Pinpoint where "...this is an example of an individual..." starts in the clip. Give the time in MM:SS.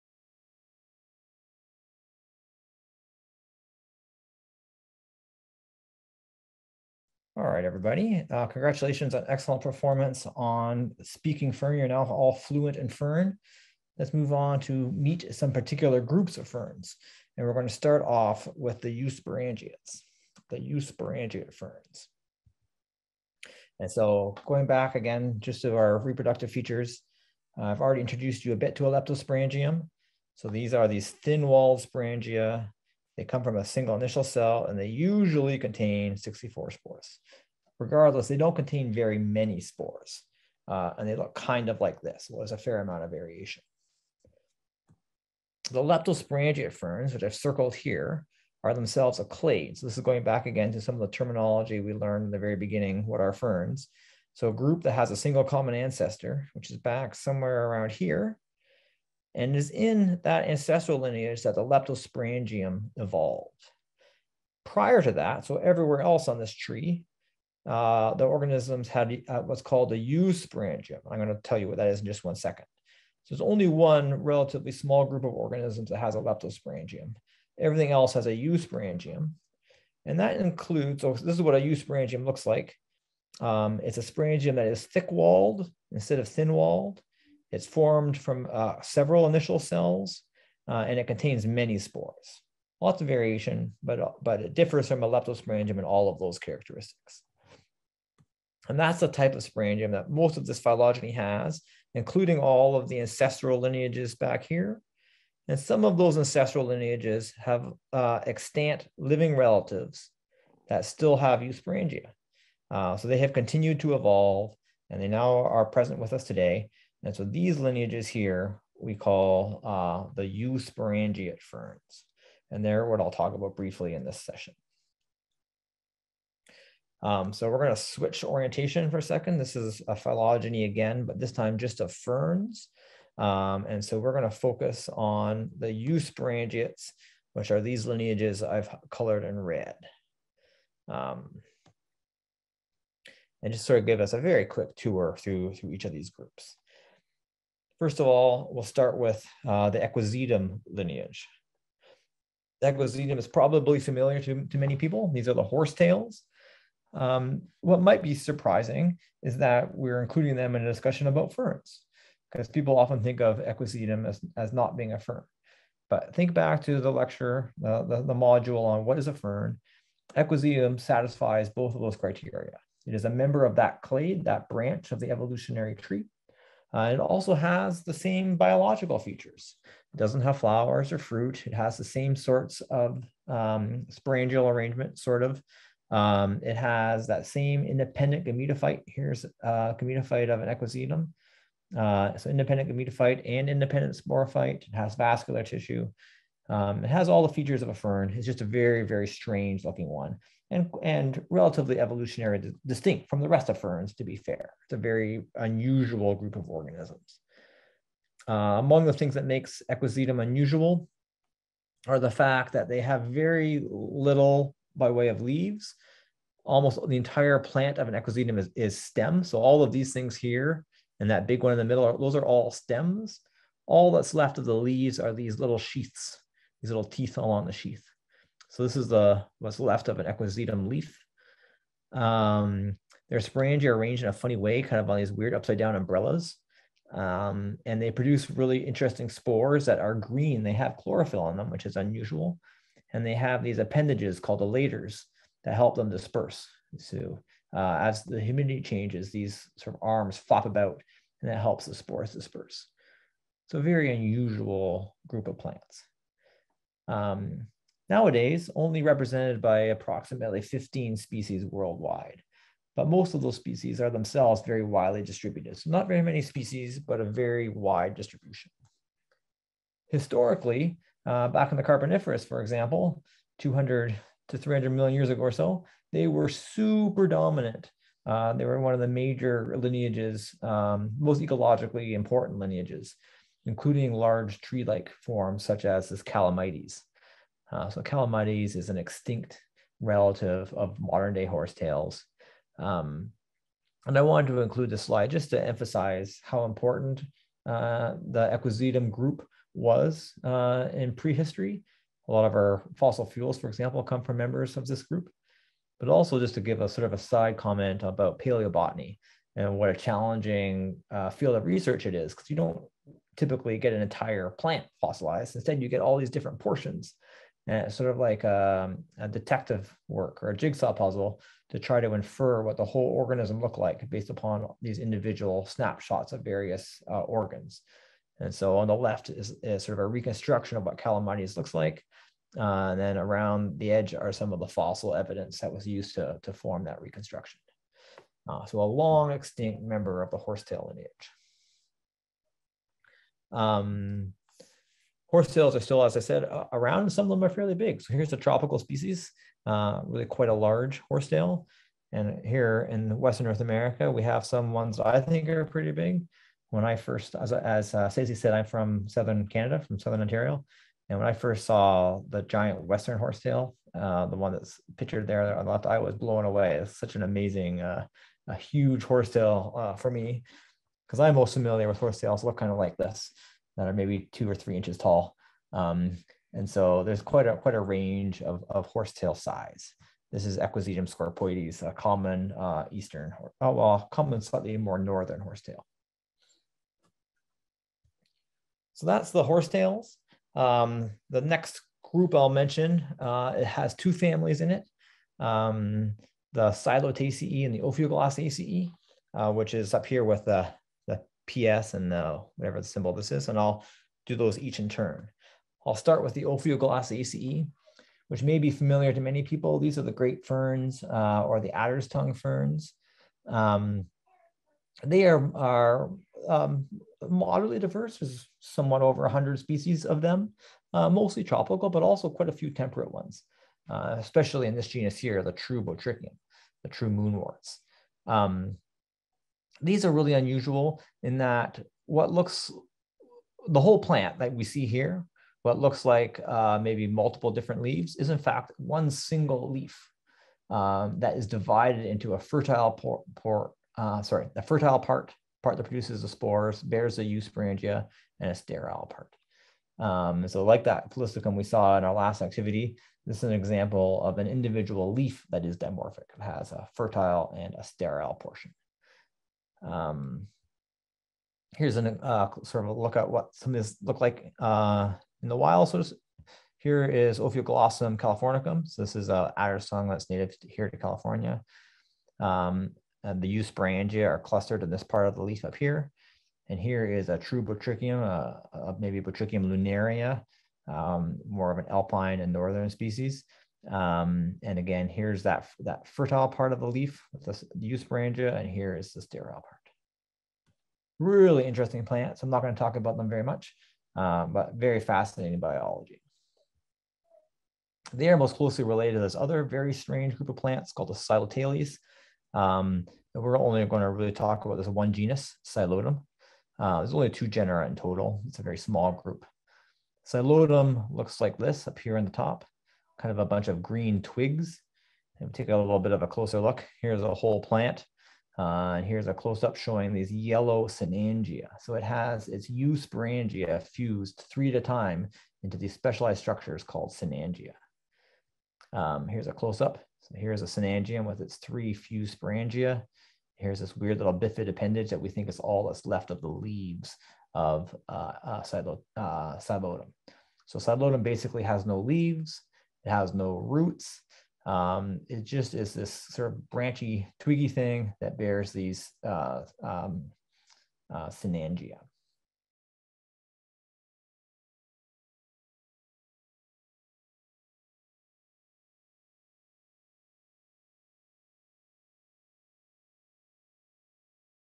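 07:33.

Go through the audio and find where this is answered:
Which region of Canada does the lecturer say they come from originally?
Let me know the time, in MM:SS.
05:59.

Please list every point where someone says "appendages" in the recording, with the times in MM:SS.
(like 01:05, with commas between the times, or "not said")
04:03, 08:54.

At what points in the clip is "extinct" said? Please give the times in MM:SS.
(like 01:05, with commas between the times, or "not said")
04:48, 05:39.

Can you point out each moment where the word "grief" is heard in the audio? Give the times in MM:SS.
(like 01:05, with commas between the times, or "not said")
not said.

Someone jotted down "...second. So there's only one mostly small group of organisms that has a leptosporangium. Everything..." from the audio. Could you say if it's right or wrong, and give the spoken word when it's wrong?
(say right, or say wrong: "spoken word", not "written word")
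wrong: "relatively", not "mostly".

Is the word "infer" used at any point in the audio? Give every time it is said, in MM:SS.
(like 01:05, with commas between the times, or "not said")
05:21.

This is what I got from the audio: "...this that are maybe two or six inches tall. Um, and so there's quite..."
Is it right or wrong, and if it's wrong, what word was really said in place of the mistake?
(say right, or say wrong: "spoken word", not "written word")
wrong: "three", not "six".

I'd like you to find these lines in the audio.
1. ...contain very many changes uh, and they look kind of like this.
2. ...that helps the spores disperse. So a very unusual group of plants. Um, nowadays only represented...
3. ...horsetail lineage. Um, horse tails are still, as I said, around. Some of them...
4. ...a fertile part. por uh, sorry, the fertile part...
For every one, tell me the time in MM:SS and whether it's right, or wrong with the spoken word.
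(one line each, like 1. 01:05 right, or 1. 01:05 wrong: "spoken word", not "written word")
1. 00:38 wrong: "spores", not "changes"
2. 04:11 right
3. 05:40 right
4. 07:22 right.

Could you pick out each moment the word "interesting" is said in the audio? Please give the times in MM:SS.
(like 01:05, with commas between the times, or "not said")
03:58, 08:11.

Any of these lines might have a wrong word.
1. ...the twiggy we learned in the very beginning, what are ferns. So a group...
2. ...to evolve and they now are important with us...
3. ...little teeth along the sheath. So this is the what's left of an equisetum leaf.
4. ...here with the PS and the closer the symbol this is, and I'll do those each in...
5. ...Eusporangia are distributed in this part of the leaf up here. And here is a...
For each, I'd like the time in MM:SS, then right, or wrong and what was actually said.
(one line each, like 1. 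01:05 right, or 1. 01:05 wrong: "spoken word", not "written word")
1. 00:51 wrong: "terminology", not "twiggy"
2. 01:53 wrong: "present", not "important"
3. 03:46 right
4. 06:39 wrong: "whatever", not "closer"
5. 07:53 wrong: "clustered", not "distributed".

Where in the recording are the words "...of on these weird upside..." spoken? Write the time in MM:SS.
03:54.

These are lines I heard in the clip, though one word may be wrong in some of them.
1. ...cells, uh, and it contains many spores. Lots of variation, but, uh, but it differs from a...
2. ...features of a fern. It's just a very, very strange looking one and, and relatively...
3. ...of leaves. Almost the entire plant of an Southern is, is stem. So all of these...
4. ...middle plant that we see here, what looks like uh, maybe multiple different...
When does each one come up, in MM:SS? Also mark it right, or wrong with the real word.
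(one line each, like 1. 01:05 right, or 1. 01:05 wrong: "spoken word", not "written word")
1. 01:29 right
2. 03:17 right
3. 03:35 wrong: "Equisetum", not "Southern"
4. 07:13 wrong: "whole", not "middle".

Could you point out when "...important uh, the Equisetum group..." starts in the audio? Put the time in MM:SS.
04:56.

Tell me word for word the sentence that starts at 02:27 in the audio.
First of all, we'll start with uh, the Equisetum lineage.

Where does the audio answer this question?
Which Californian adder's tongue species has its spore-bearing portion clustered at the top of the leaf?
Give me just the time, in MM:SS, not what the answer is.
07:47.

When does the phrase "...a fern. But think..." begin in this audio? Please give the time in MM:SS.
02:44.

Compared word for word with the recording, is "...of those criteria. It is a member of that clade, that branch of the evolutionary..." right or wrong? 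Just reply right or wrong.
right.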